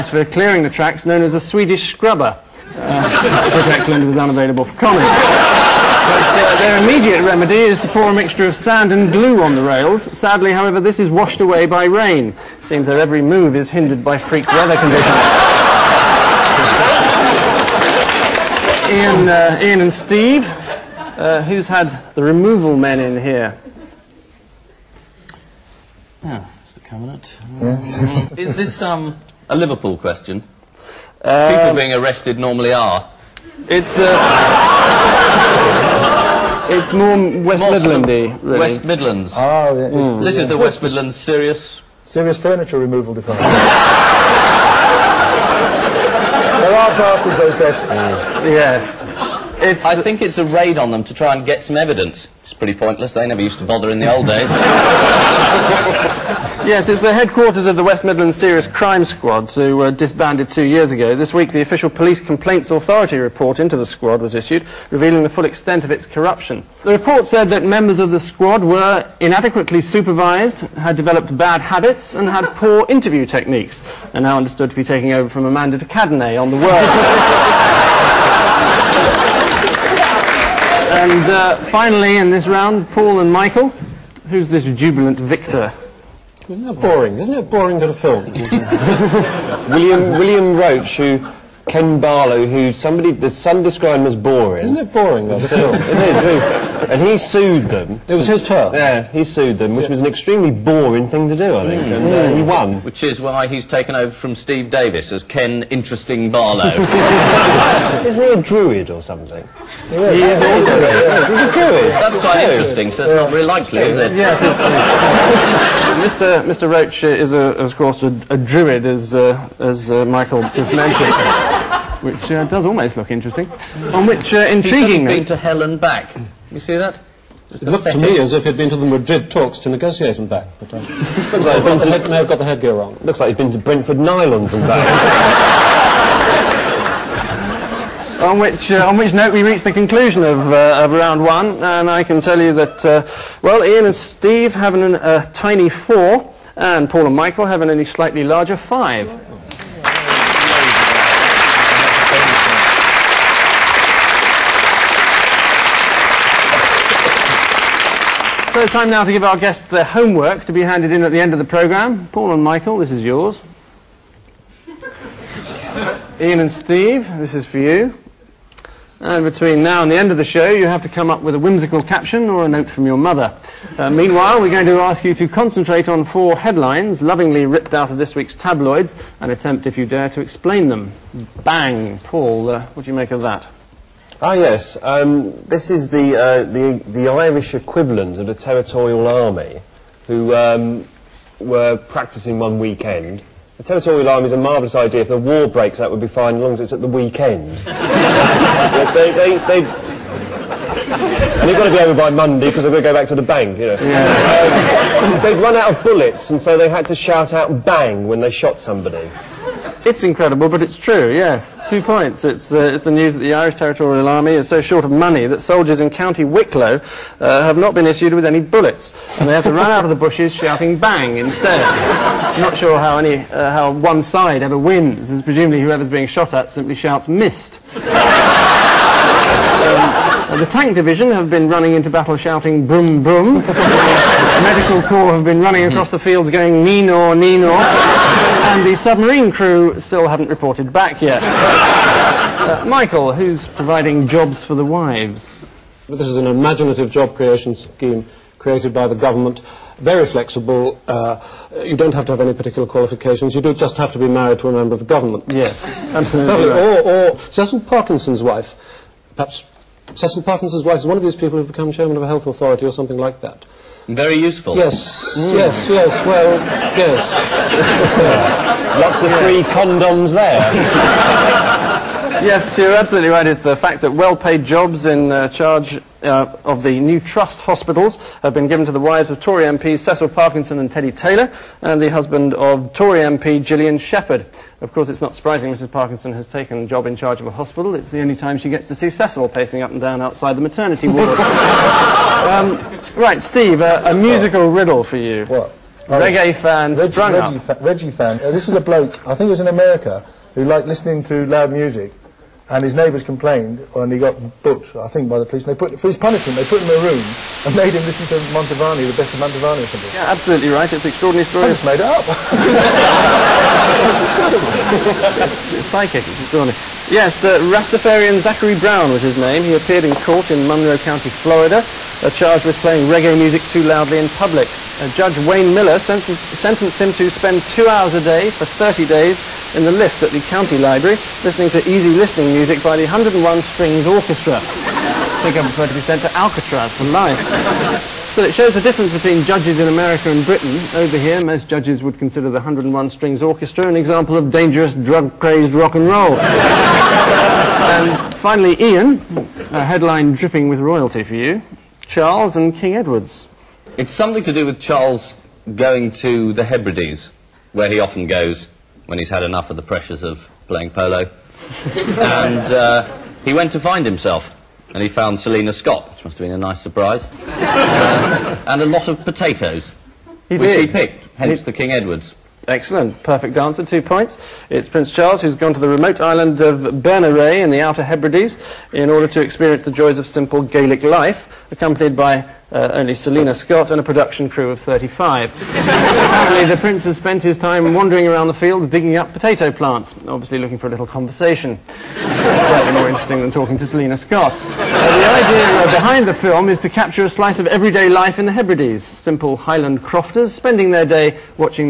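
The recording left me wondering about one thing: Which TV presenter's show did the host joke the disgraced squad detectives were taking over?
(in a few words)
Amanda de Cadenet.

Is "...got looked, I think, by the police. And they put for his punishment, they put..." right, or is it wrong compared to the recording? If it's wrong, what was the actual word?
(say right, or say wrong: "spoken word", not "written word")
wrong: "booked", not "looked".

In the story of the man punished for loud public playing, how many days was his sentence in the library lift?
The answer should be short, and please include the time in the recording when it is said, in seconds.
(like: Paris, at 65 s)
30, at 328 s.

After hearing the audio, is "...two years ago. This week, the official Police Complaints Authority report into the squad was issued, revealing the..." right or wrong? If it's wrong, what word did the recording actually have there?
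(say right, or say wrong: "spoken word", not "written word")
right.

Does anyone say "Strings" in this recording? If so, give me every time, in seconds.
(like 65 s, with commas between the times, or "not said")
333 s, 342 s.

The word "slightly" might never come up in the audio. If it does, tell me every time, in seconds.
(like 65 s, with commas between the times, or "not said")
147 s, 391 s.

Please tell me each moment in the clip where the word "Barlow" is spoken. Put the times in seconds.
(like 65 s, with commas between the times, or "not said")
91 s, 106 s.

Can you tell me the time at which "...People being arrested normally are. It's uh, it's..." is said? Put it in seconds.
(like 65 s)
31 s.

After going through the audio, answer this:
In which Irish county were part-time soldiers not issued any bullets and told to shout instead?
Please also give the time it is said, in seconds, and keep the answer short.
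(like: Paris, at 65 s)
County Wicklow, at 215 s.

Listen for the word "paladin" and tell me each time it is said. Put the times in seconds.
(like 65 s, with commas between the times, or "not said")
not said.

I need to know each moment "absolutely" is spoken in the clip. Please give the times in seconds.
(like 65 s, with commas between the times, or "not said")
255 s, 272 s, 310 s.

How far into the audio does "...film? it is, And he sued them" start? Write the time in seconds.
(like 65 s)
95 s.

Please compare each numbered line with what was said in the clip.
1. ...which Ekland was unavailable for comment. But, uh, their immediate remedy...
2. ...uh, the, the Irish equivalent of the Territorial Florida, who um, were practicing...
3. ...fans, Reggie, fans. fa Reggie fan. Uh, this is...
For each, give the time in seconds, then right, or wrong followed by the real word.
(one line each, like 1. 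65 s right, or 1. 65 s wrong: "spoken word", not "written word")
1. 3 s right
2. 186 s wrong: "Army", not "Florida"
3. 296 s right.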